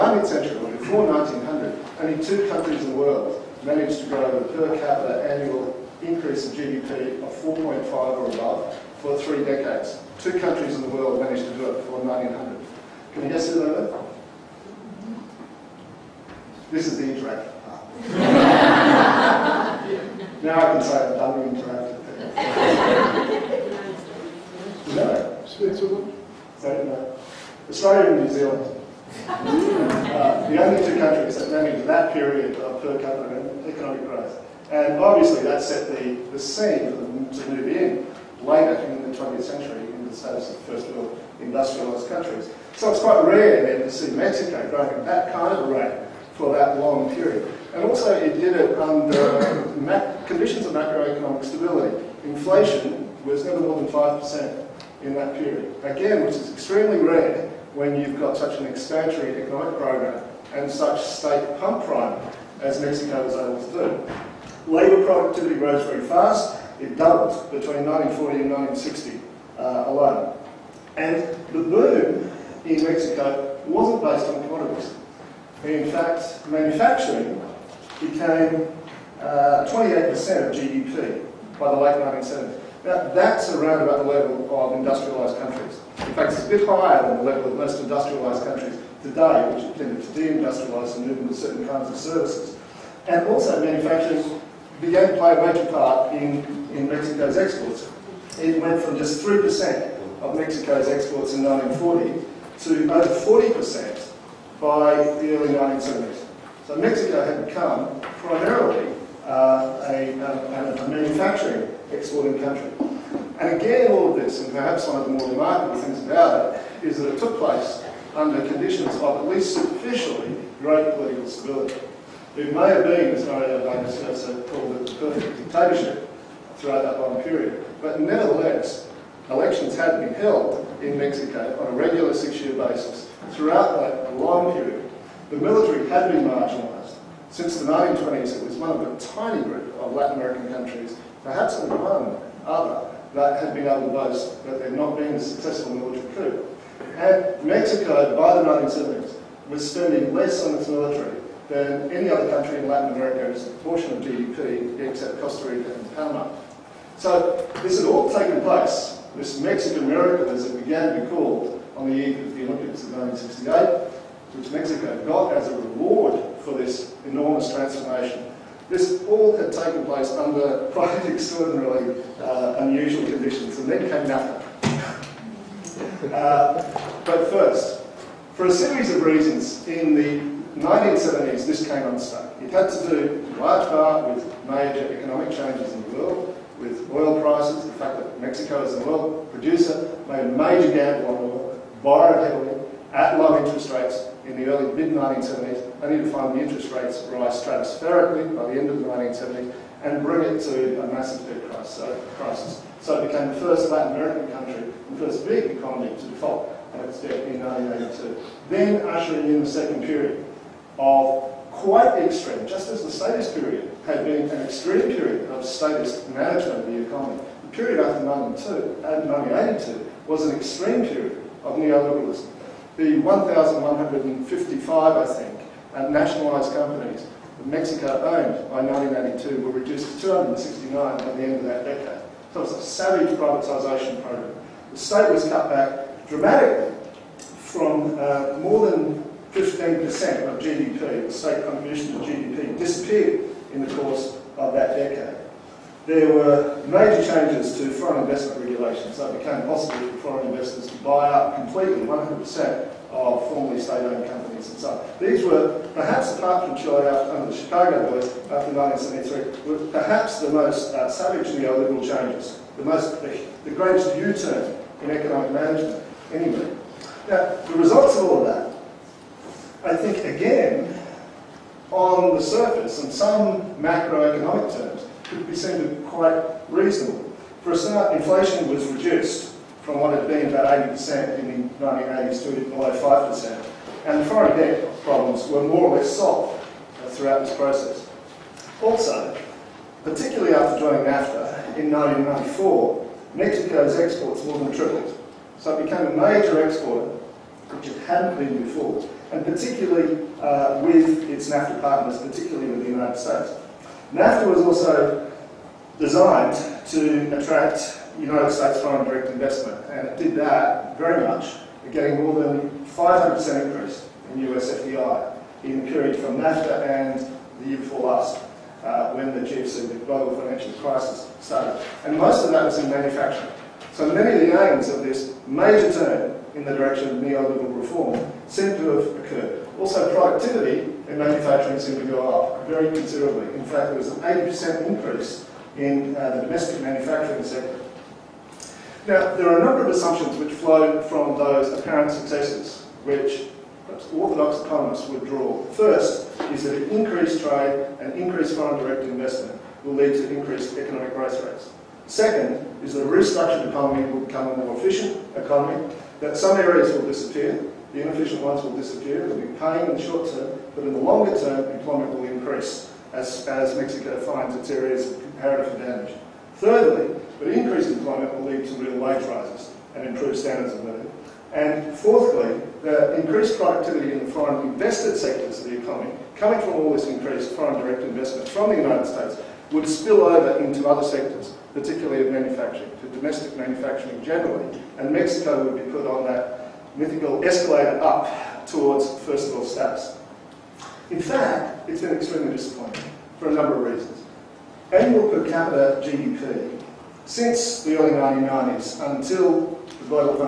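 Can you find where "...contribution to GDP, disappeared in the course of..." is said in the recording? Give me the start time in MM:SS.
04:01.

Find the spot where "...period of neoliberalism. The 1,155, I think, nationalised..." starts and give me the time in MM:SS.
03:40.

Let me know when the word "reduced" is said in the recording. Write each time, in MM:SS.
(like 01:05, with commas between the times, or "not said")
03:49, 04:38.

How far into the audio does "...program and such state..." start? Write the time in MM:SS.
00:59.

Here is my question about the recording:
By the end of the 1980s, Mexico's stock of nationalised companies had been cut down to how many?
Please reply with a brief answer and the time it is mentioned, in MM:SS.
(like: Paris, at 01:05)
269, at 03:50.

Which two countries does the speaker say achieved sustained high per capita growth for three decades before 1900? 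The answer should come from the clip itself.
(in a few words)
Australia and New Zealand.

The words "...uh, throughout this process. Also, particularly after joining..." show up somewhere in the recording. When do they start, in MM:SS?
04:46.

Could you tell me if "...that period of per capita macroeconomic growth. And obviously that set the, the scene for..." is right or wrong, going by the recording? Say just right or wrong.
wrong.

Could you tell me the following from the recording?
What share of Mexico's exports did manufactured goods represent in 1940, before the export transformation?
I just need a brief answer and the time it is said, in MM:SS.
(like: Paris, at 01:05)
3%, at 01:39.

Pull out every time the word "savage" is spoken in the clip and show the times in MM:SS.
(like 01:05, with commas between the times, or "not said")
03:52, 04:20.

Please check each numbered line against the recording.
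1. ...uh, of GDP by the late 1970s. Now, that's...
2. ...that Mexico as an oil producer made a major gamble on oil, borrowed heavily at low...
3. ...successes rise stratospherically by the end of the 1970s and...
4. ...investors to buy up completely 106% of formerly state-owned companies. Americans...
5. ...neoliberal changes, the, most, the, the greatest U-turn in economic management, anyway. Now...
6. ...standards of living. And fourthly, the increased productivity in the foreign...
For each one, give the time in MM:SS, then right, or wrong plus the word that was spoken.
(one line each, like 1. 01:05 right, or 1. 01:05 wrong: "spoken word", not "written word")
1. 01:19 right
2. 03:07 right
3. 03:16 wrong: "rates", not "successes"
4. 04:10 wrong: "100", not "106"
5. 04:21 right
6. 06:10 right.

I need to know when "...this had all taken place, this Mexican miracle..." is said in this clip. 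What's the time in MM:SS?
02:37.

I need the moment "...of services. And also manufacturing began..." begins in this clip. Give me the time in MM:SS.
01:31.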